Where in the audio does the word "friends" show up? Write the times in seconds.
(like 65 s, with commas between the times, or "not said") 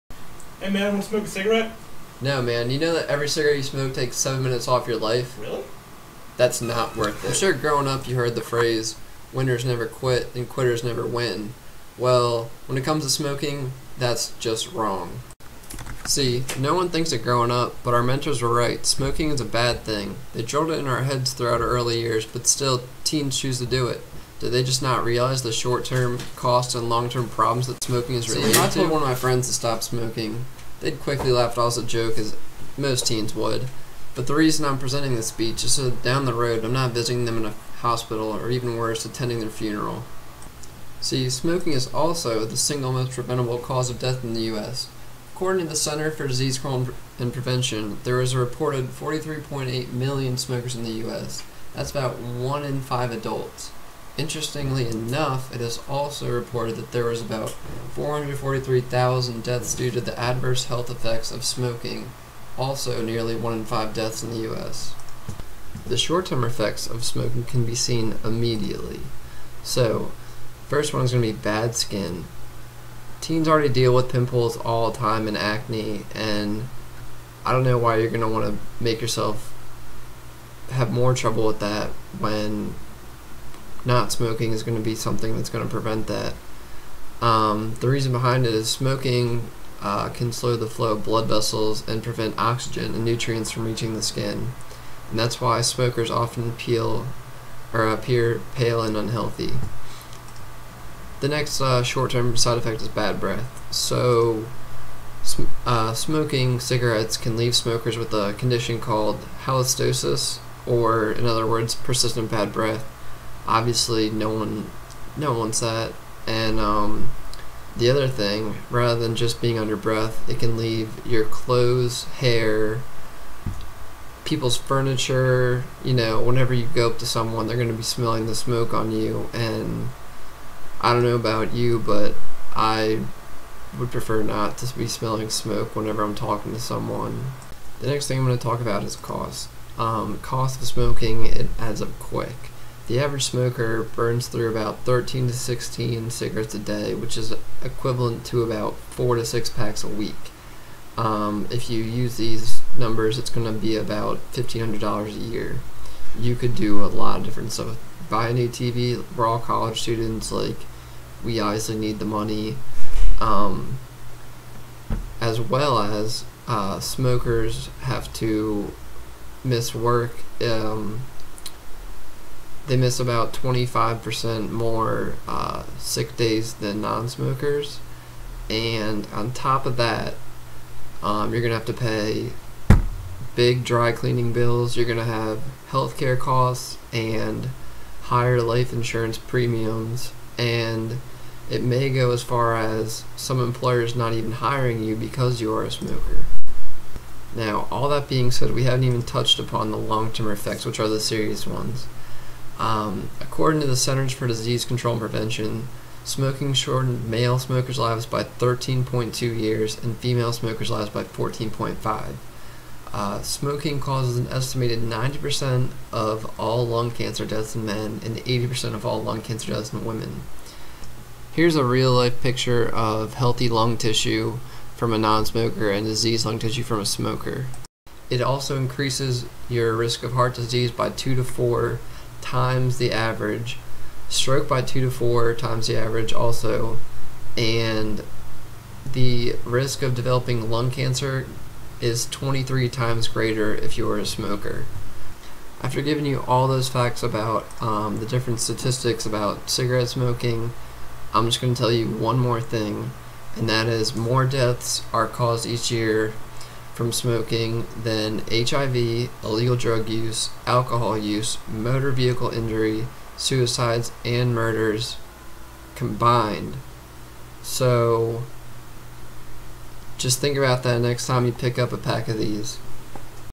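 29 s.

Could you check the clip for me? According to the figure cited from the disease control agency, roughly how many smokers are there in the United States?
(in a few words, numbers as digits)
43.8 million.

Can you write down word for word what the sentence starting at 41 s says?
See, smoking is also the single most preventable cause of death in the U.S.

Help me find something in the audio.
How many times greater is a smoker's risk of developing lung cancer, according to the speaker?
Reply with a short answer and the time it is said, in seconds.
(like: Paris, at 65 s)
23 times, at 242 s.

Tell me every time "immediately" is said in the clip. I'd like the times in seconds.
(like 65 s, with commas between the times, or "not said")
68 s.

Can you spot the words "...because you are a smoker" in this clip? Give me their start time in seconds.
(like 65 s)
194 s.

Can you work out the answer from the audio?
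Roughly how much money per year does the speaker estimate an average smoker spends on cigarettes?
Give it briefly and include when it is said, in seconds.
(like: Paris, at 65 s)
$1,500, at 154 s.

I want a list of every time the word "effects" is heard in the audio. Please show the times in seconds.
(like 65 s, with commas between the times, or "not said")
60 s, 66 s, 102 s, 200 s.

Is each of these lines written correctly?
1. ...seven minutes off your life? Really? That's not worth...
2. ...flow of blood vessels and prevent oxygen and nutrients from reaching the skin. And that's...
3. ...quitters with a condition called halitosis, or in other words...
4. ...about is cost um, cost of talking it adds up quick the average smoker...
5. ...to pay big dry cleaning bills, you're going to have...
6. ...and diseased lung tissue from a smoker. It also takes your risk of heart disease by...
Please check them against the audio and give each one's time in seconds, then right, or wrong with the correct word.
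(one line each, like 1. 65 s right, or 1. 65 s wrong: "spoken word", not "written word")
1. 4 s right
2. 90 s right
3. 107 s wrong: "smokers", not "quitters"
4. 138 s wrong: "smoking", not "talking"
5. 181 s right
6. 225 s wrong: "increases", not "takes".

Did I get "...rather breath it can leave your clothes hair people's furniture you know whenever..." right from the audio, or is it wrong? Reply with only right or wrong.
wrong.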